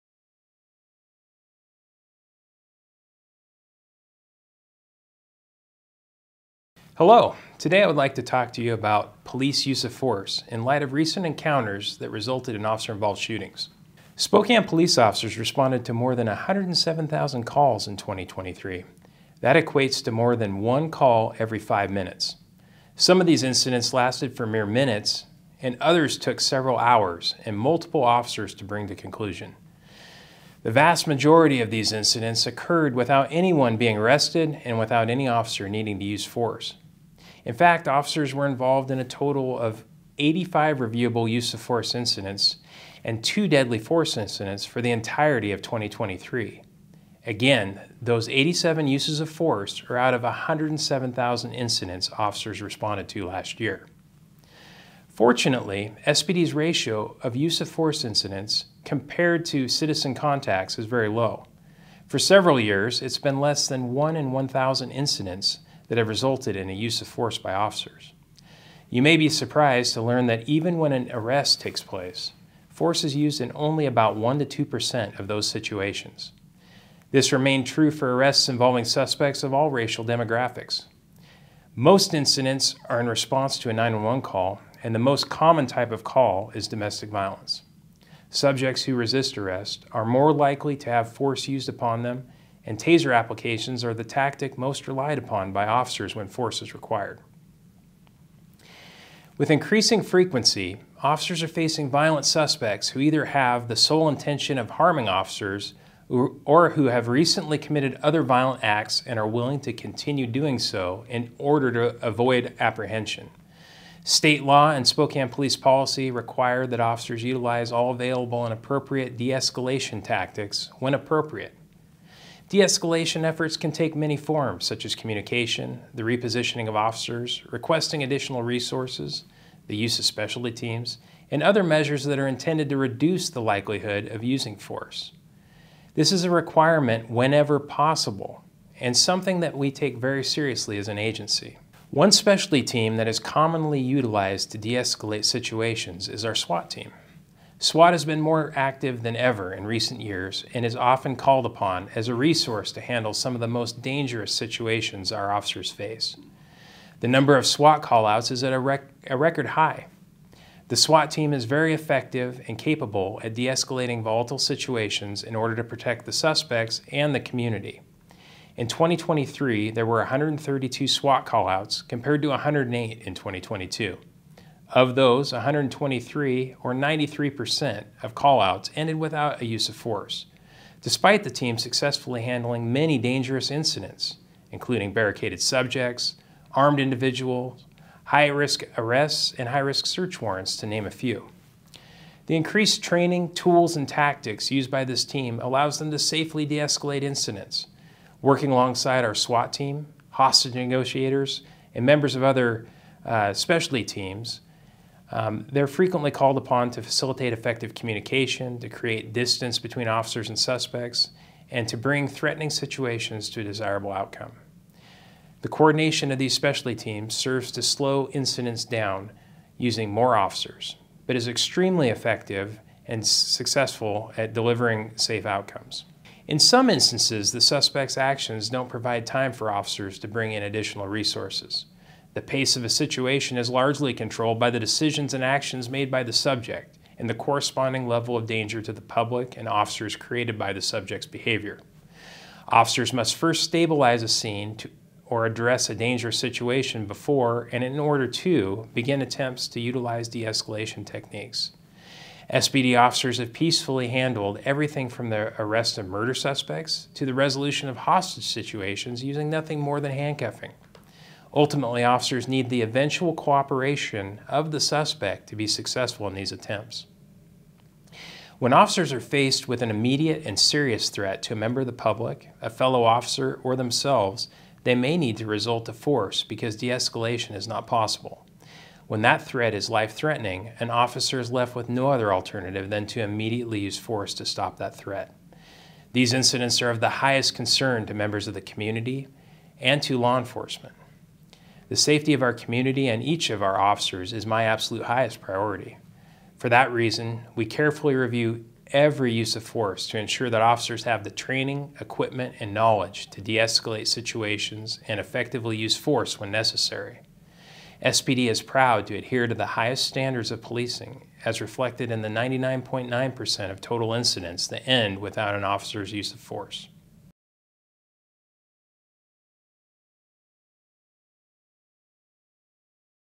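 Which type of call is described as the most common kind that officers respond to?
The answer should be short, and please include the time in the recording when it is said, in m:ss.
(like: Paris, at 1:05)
domestic violence, at 1:26.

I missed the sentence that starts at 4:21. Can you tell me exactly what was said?
Ultimately, officers need the eventual cooperation of the suspect to be successful in these attempts.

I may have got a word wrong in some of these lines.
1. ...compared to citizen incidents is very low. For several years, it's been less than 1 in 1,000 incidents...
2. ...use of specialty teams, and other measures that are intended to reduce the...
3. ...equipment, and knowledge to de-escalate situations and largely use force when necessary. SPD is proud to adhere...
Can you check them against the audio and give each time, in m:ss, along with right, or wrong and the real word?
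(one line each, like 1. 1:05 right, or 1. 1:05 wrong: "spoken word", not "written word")
1. 0:58 wrong: "contacts", not "incidents"
2. 2:09 right
3. 5:01 wrong: "effectively", not "largely".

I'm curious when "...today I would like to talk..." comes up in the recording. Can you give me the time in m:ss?
0:07.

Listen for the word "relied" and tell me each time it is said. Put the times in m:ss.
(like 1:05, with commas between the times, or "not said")
1:34.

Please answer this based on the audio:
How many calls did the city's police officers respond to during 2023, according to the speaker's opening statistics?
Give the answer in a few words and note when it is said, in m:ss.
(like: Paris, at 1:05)
more than 107,000, at 0:15.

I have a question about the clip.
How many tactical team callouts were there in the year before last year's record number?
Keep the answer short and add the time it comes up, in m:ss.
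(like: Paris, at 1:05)
108, at 2:52.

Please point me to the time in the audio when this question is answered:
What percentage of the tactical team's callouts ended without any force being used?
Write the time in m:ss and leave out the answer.
2:56.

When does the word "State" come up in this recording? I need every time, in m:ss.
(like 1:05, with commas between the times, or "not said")
1:54.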